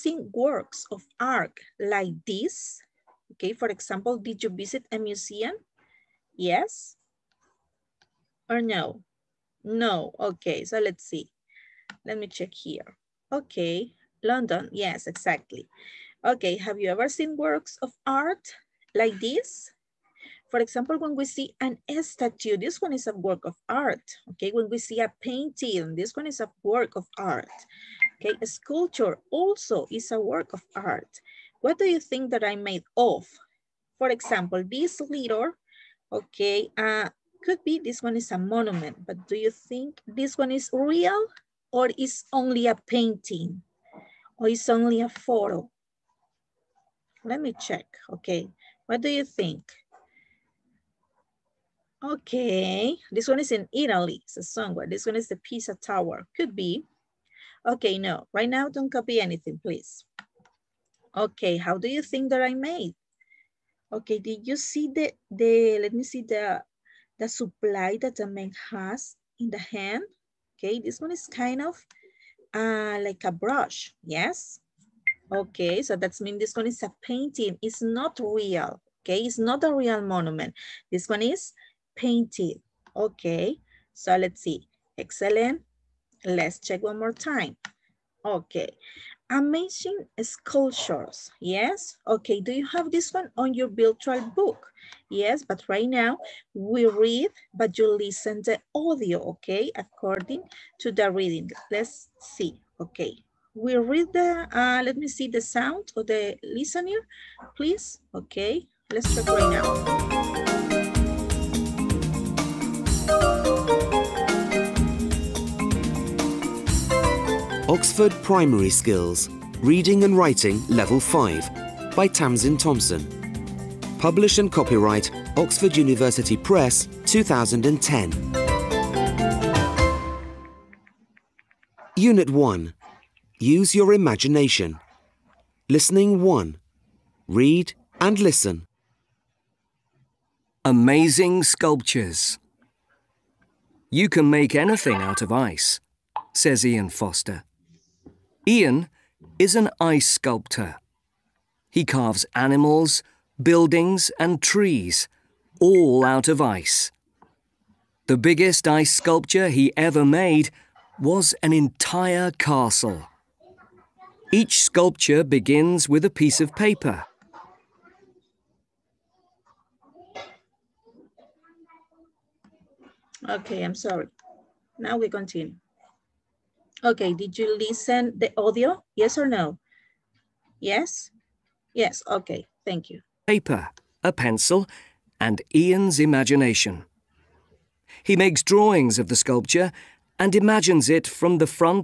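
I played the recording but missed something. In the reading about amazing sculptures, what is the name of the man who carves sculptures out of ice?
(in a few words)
Ian Foster.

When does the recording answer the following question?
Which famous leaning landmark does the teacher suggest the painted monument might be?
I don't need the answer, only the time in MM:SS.
00:55.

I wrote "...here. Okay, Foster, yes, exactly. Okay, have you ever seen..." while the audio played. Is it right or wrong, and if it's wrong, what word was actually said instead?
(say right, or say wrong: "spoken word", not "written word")
wrong: "London", not "Foster".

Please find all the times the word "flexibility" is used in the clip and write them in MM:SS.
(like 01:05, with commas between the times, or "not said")
not said.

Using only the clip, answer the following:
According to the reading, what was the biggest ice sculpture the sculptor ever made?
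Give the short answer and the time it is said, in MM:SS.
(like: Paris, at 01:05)
An entire castle, at 02:41.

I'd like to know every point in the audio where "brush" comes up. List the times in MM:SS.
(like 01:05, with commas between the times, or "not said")
01:13.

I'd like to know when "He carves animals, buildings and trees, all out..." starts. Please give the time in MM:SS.
02:31.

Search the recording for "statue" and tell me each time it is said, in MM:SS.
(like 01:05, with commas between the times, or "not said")
00:22.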